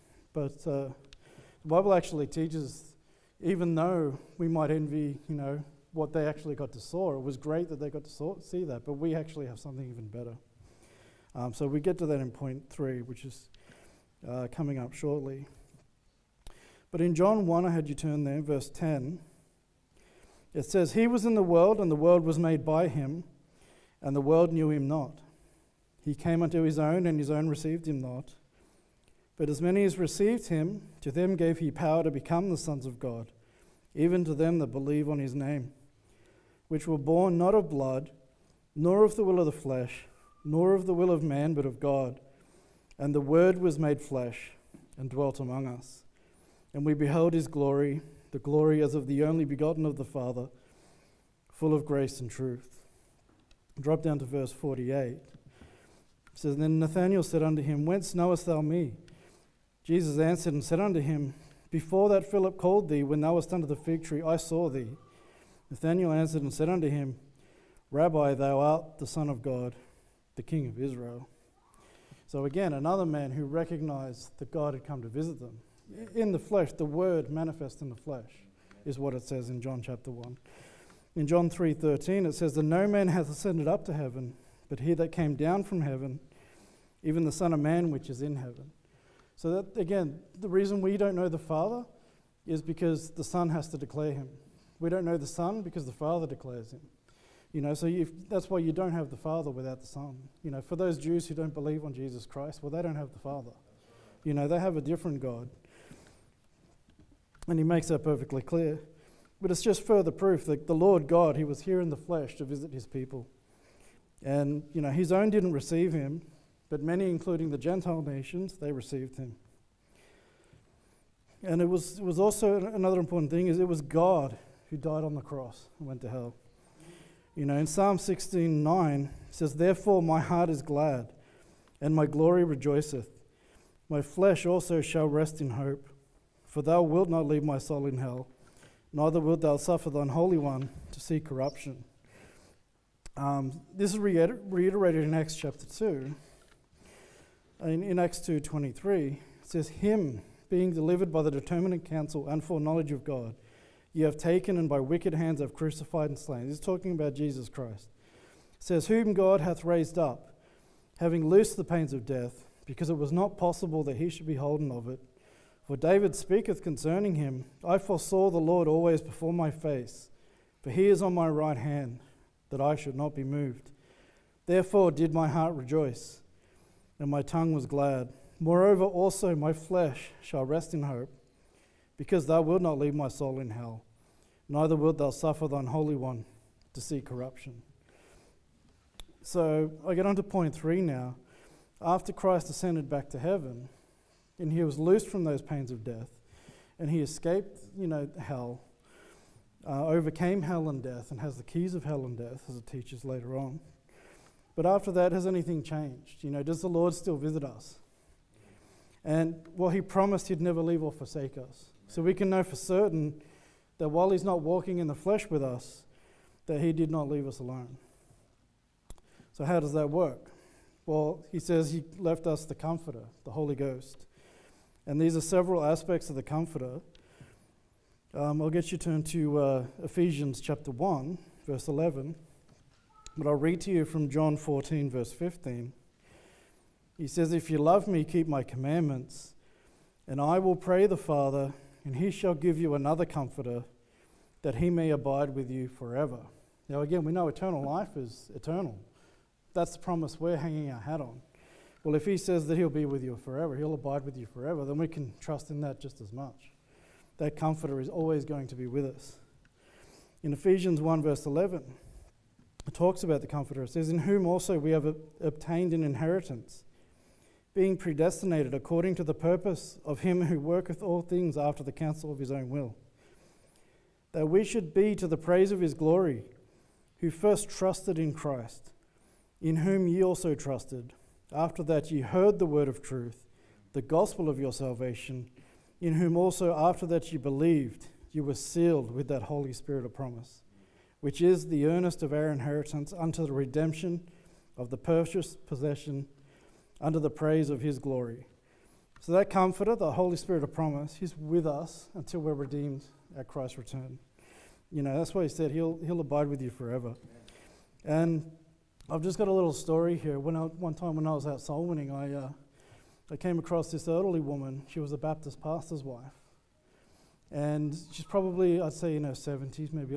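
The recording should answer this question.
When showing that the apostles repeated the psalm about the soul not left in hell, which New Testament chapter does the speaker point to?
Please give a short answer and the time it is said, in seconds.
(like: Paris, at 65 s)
Acts chapter 2, at 145 s.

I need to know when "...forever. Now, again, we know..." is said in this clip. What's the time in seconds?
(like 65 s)
245 s.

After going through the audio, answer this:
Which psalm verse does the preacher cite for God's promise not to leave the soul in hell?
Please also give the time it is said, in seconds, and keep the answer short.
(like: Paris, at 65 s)
Psalm 16:9, at 127 s.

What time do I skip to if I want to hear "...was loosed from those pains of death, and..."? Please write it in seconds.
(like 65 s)
194 s.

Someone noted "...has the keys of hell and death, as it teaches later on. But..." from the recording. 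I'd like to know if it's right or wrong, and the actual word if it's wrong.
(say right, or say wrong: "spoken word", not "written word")
right.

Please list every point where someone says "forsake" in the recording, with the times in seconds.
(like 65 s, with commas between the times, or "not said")
210 s.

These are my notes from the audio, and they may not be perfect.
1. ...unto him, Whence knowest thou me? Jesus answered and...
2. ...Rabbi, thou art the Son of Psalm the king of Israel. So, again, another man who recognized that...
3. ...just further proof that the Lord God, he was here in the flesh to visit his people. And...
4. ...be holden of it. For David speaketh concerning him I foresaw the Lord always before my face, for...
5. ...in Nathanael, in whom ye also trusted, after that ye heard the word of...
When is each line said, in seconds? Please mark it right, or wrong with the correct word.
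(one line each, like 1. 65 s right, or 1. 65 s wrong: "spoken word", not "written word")
1. 57 s right
2. 67 s wrong: "God", not "Psalm"
3. 109 s right
4. 164 s right
5. 277 s wrong: "Christ", not "Nathanael".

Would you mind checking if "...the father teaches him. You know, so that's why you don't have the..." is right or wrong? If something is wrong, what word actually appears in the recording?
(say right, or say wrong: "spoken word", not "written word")
wrong: "declares", not "teaches".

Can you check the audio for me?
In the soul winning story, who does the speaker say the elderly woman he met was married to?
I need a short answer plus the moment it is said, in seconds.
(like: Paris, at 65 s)
A Baptist pastor's, at 314 s.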